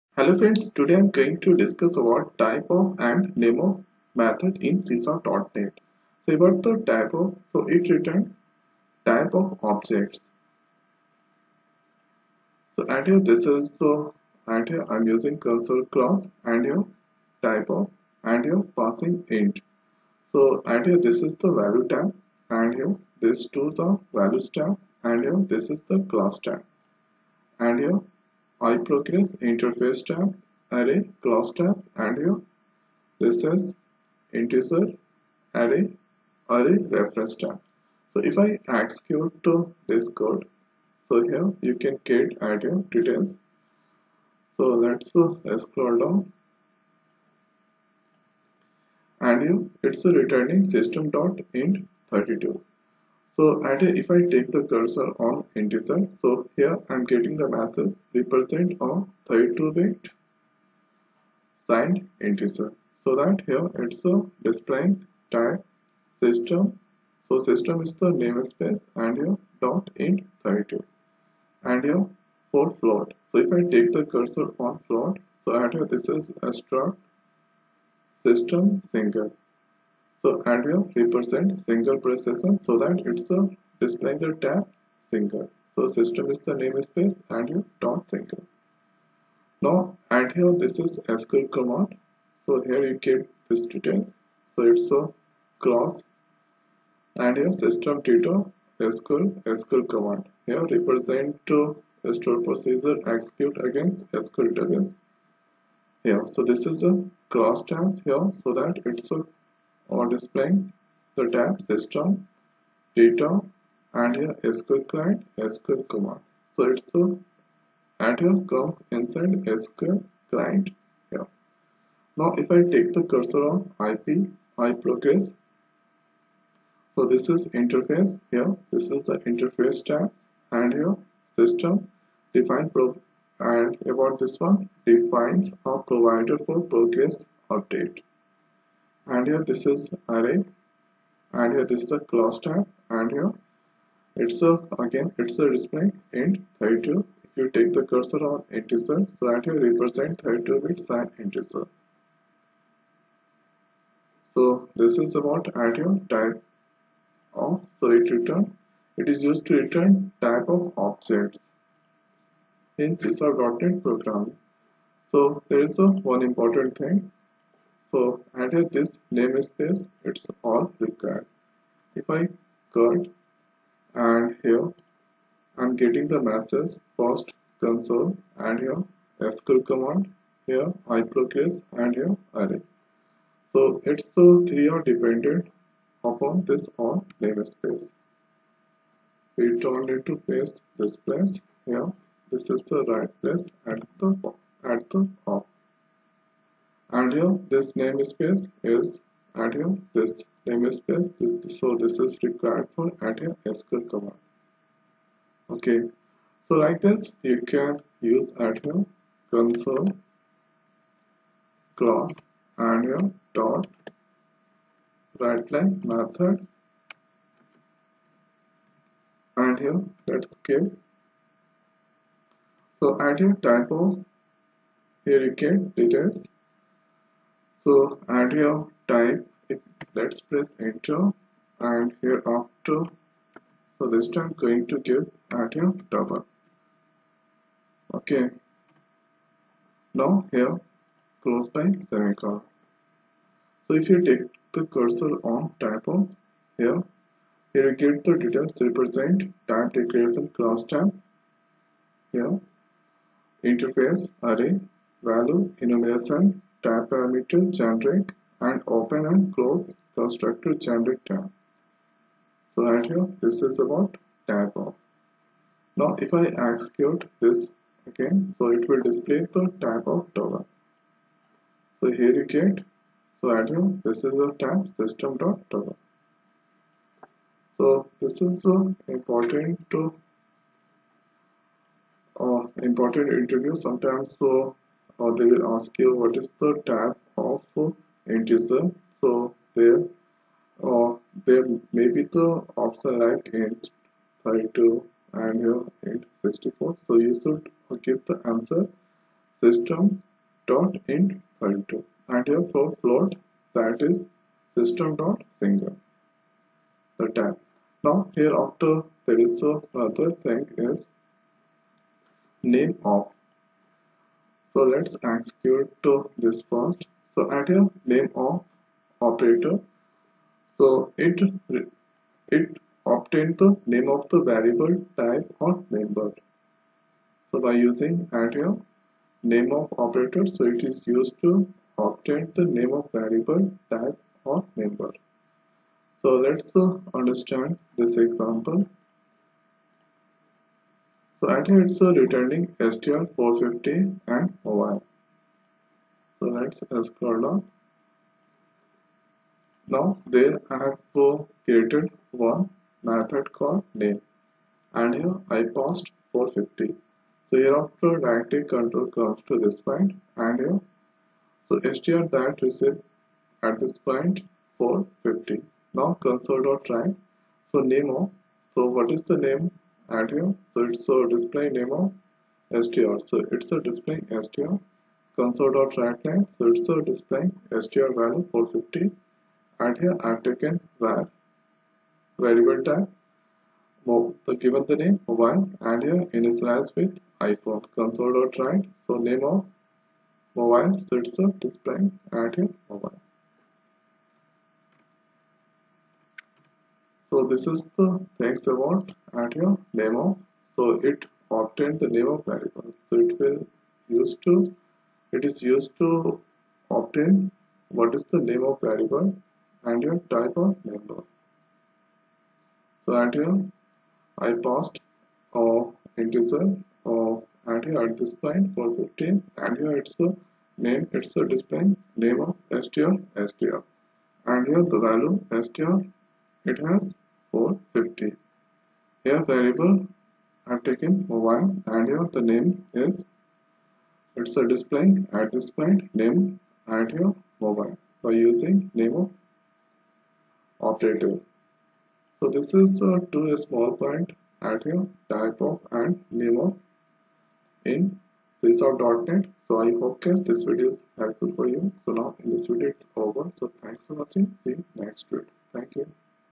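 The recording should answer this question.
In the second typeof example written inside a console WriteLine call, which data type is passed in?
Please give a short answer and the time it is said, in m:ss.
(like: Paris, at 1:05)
double, at 3:55.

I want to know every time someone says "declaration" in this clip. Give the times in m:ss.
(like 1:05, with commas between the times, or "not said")
4:09.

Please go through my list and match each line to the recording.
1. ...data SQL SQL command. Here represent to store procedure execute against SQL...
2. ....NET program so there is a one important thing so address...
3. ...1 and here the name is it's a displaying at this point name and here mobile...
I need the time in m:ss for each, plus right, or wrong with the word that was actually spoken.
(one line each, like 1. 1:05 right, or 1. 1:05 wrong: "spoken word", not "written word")
1. 1:38 right
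2. 2:43 right
3. 7:11 right.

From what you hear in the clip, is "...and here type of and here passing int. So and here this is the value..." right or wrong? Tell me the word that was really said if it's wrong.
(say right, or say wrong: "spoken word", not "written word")
right.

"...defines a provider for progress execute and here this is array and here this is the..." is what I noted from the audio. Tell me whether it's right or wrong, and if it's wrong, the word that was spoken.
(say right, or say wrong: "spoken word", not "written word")
wrong: "update", not "execute".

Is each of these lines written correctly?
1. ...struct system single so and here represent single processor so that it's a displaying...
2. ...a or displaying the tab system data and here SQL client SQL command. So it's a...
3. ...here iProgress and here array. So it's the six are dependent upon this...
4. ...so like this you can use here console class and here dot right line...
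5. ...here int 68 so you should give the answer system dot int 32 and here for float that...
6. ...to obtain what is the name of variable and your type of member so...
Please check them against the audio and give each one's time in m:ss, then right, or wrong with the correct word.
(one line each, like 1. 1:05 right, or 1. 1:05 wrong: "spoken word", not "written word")
1. 1:16 right
2. 1:49 right
3. 3:00 wrong: "three", not "six"
4. 3:26 right
5. 4:55 wrong: "64", not "68"
6. 6:45 wrong: "number", not "member".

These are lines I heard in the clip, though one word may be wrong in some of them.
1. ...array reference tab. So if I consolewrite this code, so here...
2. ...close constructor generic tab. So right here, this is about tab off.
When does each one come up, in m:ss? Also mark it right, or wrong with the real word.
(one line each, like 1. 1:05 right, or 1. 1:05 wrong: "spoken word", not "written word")
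1. 0:36 wrong: "execute", not "consolewrite"
2. 4:19 right.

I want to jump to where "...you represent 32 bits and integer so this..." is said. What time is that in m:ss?
2:29.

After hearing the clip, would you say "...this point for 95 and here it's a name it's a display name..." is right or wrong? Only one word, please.
wrong.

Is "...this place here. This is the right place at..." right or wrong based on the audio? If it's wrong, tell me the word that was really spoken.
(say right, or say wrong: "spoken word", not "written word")
right.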